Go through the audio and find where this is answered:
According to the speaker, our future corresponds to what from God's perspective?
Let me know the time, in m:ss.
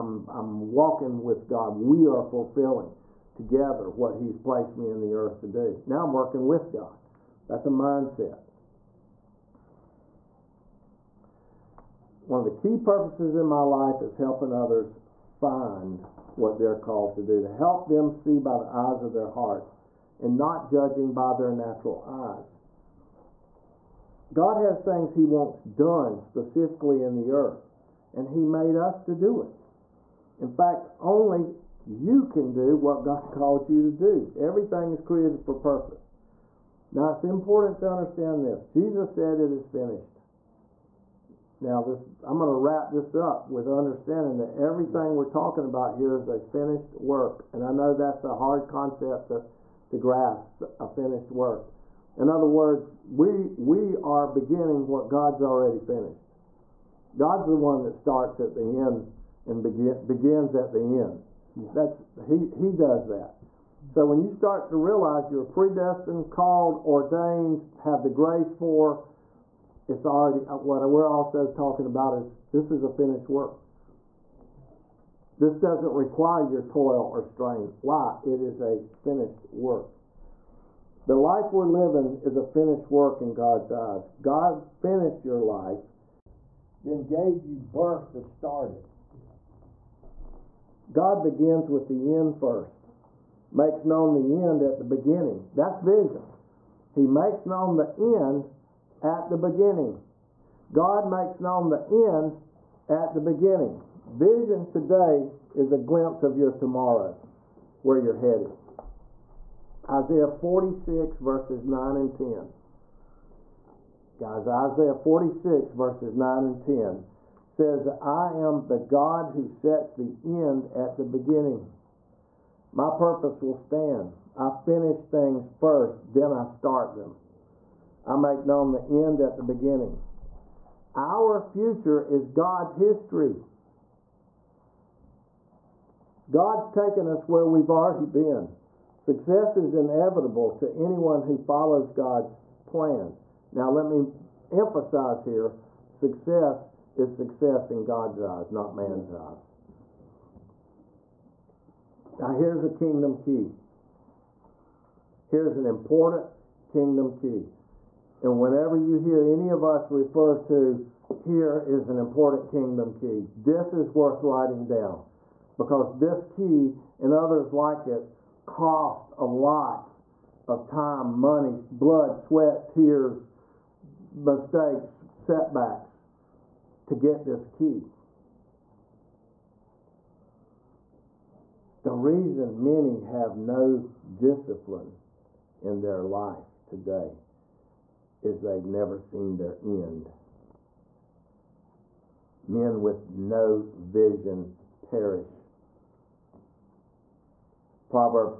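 2:12.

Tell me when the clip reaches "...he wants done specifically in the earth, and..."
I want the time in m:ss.
0:25.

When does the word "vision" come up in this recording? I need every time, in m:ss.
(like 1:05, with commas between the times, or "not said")
1:35, 1:44, 3:13.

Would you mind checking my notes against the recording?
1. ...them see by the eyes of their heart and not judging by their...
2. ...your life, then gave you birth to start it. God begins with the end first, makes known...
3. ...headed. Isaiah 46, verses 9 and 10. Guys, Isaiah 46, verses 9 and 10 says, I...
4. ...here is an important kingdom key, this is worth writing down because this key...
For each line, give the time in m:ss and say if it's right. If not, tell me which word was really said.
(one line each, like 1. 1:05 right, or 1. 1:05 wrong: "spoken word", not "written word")
1. 0:17 right
2. 1:25 right
3. 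1:48 right
4. 2:41 right.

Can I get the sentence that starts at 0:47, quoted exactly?
And I know that's a hard concept to, to grasp, a finished work.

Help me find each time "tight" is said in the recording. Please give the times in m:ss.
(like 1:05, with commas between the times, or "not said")
not said.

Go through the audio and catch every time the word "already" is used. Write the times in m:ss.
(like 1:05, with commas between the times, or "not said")
0:55, 1:10, 2:17.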